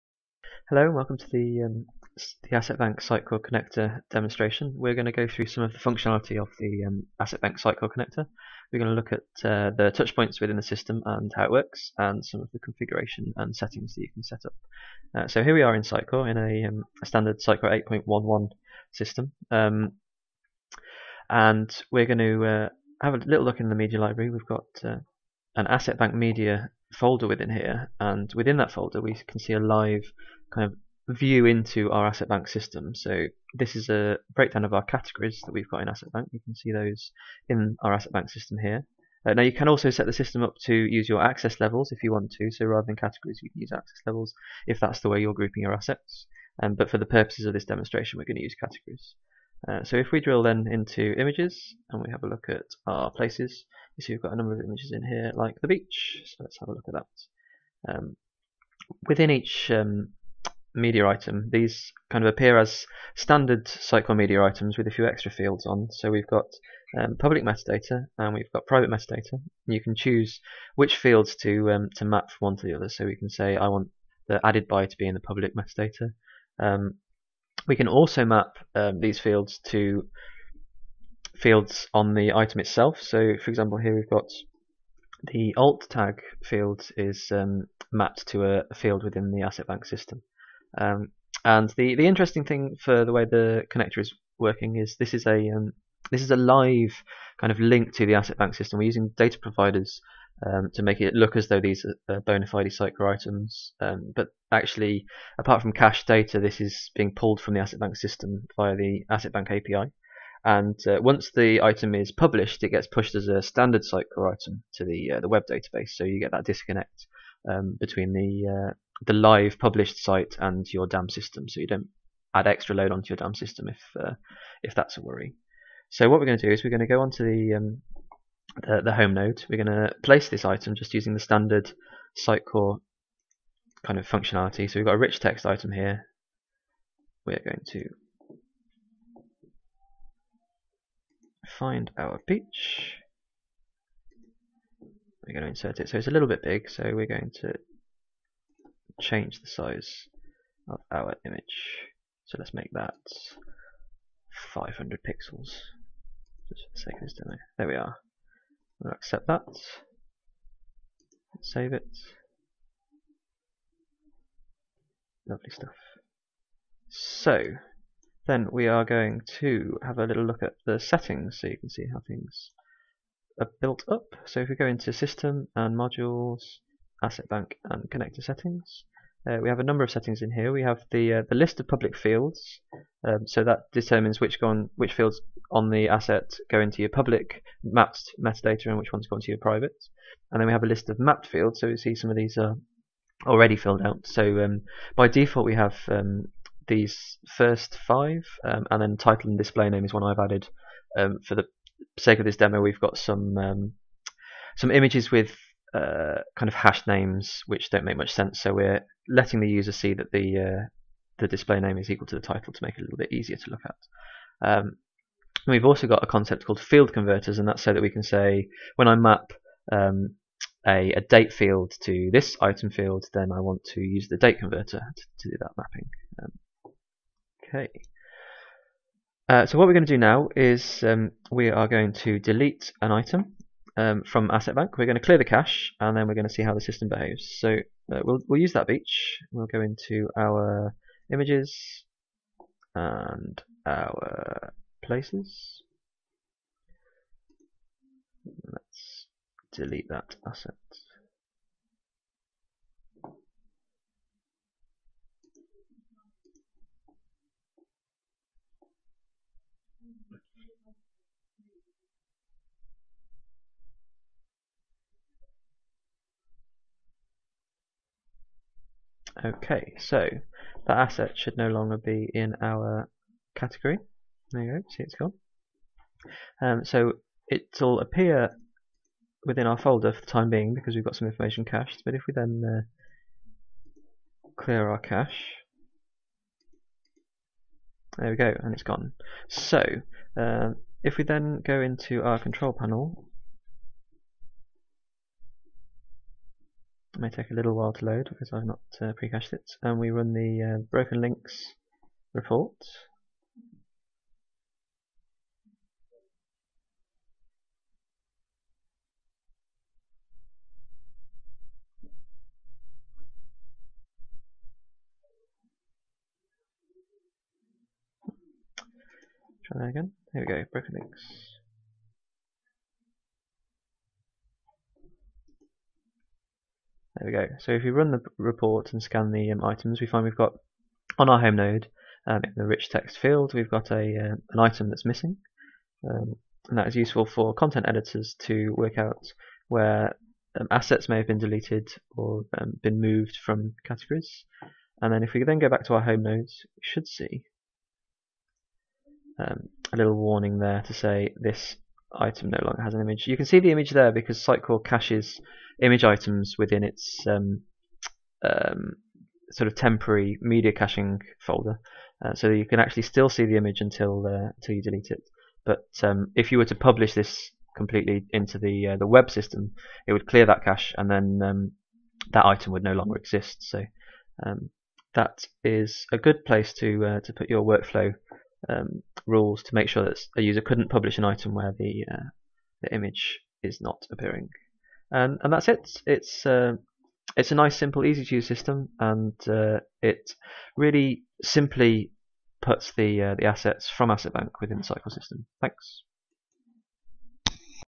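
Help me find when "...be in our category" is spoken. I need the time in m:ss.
4:31.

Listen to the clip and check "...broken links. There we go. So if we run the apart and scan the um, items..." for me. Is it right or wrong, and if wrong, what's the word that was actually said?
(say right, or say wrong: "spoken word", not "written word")
wrong: "report", not "apart".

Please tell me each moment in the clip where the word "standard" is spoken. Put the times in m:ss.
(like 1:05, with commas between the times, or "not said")
0:17, 1:03, 1:53, 2:11.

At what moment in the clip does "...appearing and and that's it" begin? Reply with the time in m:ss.
6:23.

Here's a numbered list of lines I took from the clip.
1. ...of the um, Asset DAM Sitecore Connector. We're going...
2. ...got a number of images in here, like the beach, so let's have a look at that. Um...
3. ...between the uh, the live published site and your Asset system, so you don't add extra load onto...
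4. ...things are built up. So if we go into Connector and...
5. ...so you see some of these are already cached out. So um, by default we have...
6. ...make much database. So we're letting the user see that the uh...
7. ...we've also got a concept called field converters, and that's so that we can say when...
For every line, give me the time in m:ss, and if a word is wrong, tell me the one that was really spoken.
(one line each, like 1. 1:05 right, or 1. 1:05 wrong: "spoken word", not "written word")
1. 0:06 wrong: "Bank", not "DAM"
2. 0:54 right
3. 1:57 wrong: "DAM", not "Asset"
4. 2:52 wrong: "System", not "Connector"
5. 3:11 wrong: "filled", not "cached"
6. 3:27 wrong: "sense", not "database"
7. 3:35 right.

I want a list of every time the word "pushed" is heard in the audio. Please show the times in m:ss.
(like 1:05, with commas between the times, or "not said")
1:52.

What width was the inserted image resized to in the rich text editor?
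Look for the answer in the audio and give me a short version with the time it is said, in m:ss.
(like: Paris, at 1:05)
500 pixels, at 2:34.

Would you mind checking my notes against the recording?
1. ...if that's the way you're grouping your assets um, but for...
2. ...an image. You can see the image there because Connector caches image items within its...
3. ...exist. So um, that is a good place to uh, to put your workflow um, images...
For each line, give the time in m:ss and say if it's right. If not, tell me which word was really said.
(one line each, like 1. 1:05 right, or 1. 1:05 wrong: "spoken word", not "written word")
1. 0:44 right
2. 5:52 wrong: "Sitecore", not "Connector"
3. 6:12 wrong: "rules", not "images".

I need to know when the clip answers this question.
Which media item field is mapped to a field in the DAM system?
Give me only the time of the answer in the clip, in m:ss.
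1:25.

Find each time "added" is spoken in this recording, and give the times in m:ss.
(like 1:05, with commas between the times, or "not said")
1:14, 3:20.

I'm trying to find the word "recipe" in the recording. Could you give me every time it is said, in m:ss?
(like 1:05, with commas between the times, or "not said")
not said.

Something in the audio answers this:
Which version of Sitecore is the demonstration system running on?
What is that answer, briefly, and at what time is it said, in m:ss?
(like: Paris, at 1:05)
8.11, at 0:18.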